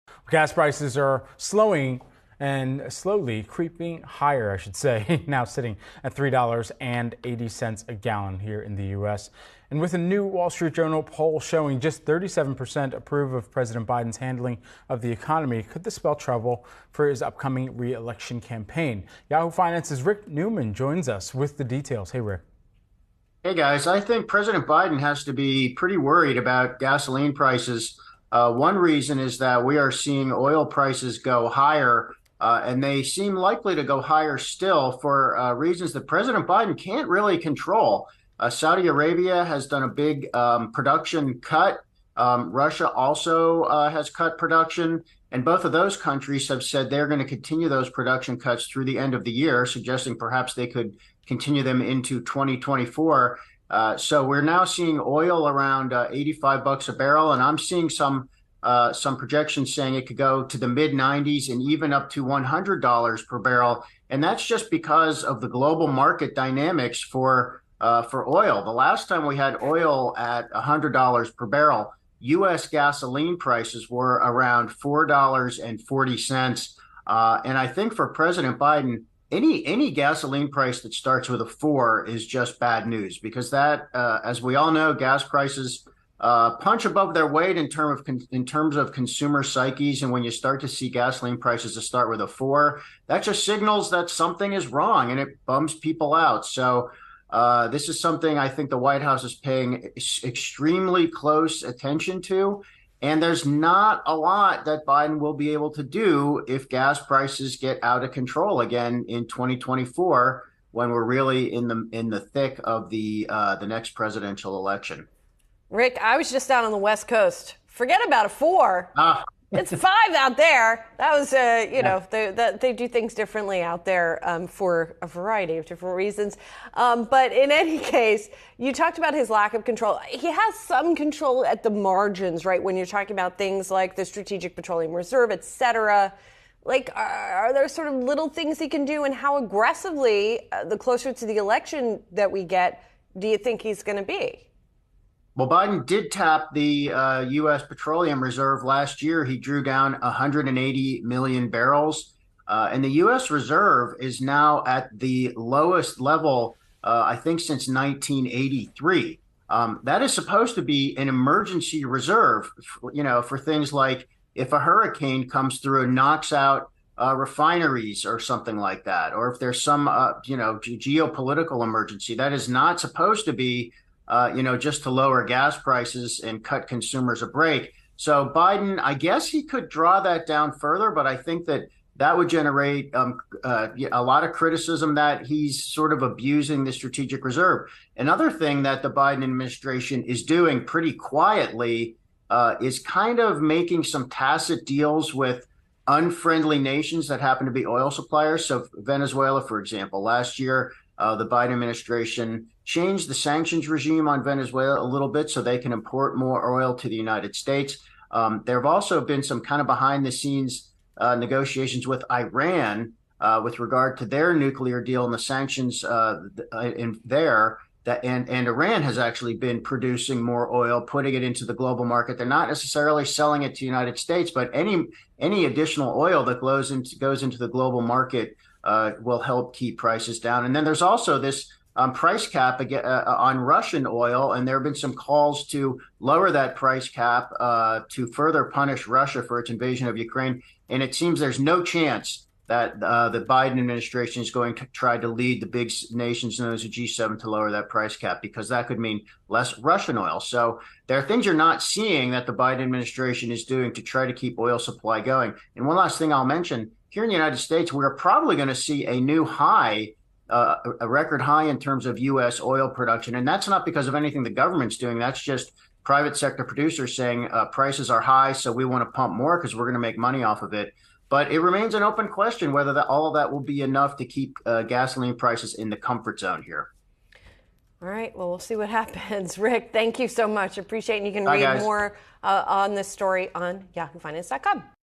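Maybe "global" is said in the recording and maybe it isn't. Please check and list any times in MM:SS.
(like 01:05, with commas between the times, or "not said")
01:05, 03:41, 03:47.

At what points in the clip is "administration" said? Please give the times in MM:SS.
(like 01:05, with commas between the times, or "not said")
03:09, 03:21, 04:03, 04:12.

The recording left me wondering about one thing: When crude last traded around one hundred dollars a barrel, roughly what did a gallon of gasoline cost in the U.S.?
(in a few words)
$4.40.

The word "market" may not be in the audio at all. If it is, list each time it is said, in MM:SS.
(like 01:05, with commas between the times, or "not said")
01:05, 03:41, 03:47.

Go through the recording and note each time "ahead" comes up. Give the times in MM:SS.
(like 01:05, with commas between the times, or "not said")
not said.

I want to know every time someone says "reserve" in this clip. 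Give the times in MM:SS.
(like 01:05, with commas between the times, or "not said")
02:14, 02:28, 02:33, 02:41, 03:07.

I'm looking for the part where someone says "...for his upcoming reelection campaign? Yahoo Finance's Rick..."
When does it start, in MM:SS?
00:16.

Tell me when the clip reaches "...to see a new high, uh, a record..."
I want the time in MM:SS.
04:18.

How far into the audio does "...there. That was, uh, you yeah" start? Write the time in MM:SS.
02:00.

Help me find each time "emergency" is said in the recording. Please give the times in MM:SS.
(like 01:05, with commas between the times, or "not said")
02:41, 02:51.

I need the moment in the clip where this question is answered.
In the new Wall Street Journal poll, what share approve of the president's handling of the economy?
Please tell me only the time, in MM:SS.
00:12.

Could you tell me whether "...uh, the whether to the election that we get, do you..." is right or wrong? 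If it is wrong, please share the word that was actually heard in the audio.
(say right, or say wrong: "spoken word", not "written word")
wrong: "closer", not "whether".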